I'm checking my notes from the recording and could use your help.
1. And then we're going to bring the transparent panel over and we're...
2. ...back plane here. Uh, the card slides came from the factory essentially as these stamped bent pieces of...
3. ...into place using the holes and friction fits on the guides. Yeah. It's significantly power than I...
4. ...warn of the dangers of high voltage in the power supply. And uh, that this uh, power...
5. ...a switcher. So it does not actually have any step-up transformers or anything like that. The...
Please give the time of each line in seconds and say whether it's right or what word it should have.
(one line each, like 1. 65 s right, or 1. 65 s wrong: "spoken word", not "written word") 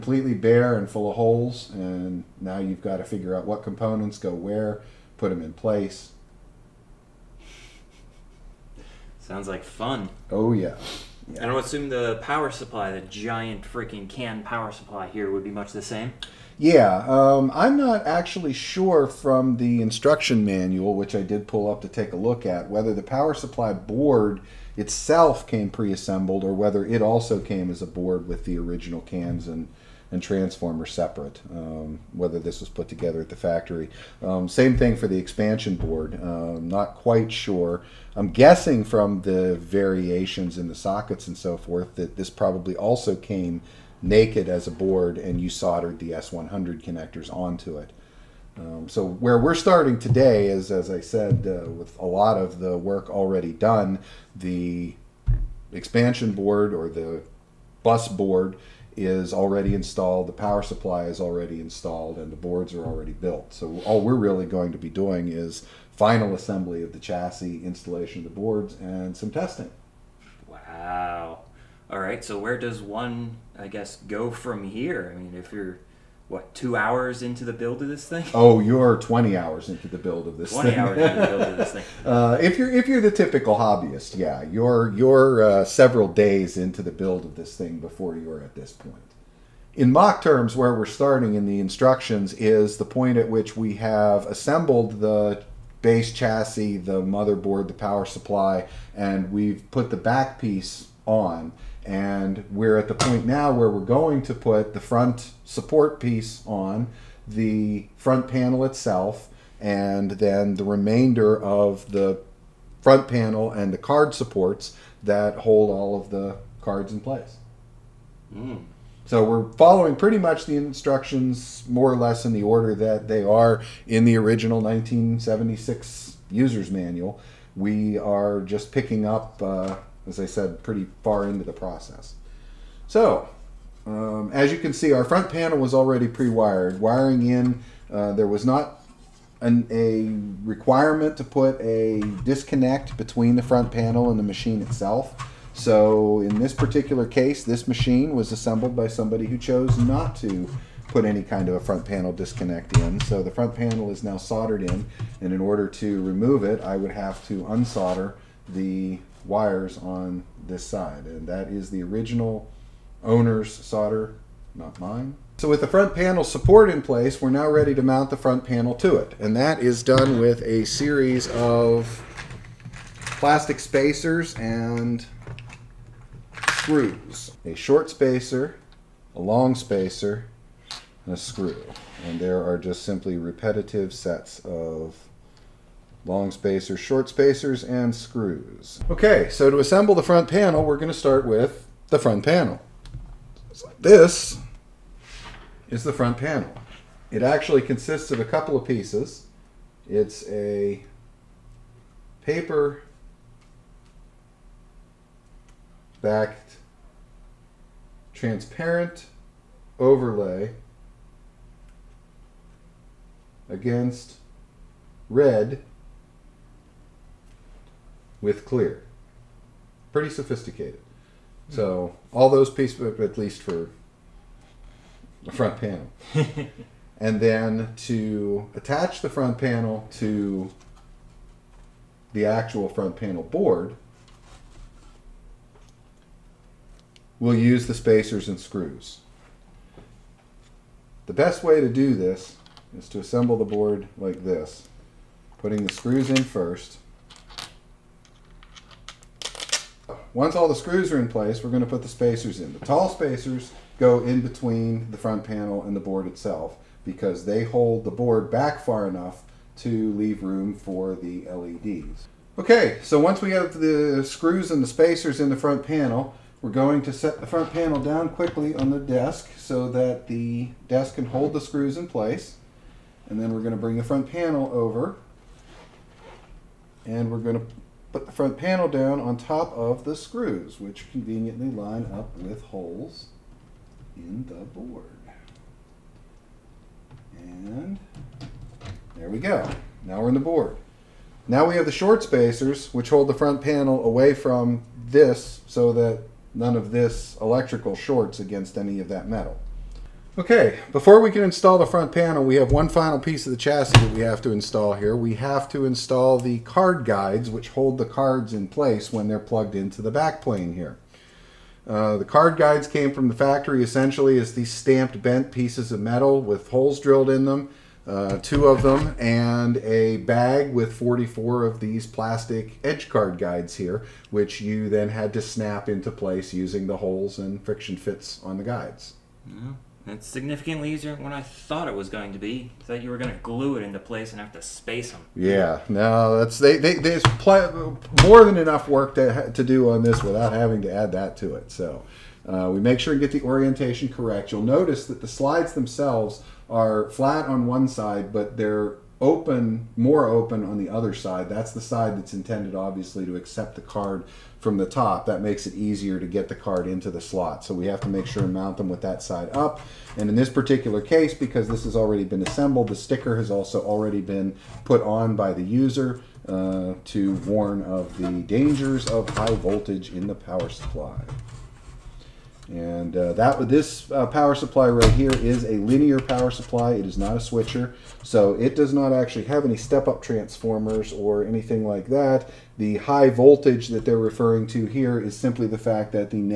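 1. 273 s wrong: "front", not "transparent"
2. 309 s wrong: "guides", not "slides"
3. 325 s wrong: "easier", not "power"
4. 367 s right
5. 377 s right.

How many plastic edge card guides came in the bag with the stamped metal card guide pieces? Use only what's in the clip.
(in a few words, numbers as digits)
44.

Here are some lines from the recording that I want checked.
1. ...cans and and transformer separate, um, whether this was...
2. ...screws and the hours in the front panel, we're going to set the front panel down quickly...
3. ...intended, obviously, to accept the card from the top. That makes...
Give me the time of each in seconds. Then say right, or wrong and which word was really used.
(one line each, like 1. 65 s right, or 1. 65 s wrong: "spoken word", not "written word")
1. 29 s right
2. 264 s wrong: "spacers", not "hours"
3. 352 s right.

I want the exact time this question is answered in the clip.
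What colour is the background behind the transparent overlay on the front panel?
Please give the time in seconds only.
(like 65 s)
215 s.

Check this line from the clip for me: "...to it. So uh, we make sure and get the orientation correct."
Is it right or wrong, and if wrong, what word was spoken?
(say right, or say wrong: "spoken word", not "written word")
right.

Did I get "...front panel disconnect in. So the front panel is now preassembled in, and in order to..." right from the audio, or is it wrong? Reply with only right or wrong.
wrong.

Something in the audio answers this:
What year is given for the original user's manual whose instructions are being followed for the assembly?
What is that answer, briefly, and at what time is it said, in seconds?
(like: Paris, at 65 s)
1976, at 124 s.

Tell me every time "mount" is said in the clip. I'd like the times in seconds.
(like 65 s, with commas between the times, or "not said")
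167 s, 358 s.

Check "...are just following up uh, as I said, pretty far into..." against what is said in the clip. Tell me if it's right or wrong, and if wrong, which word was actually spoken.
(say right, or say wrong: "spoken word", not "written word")
wrong: "picking", not "following".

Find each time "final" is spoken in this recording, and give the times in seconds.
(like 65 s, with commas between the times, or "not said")
65 s, 302 s.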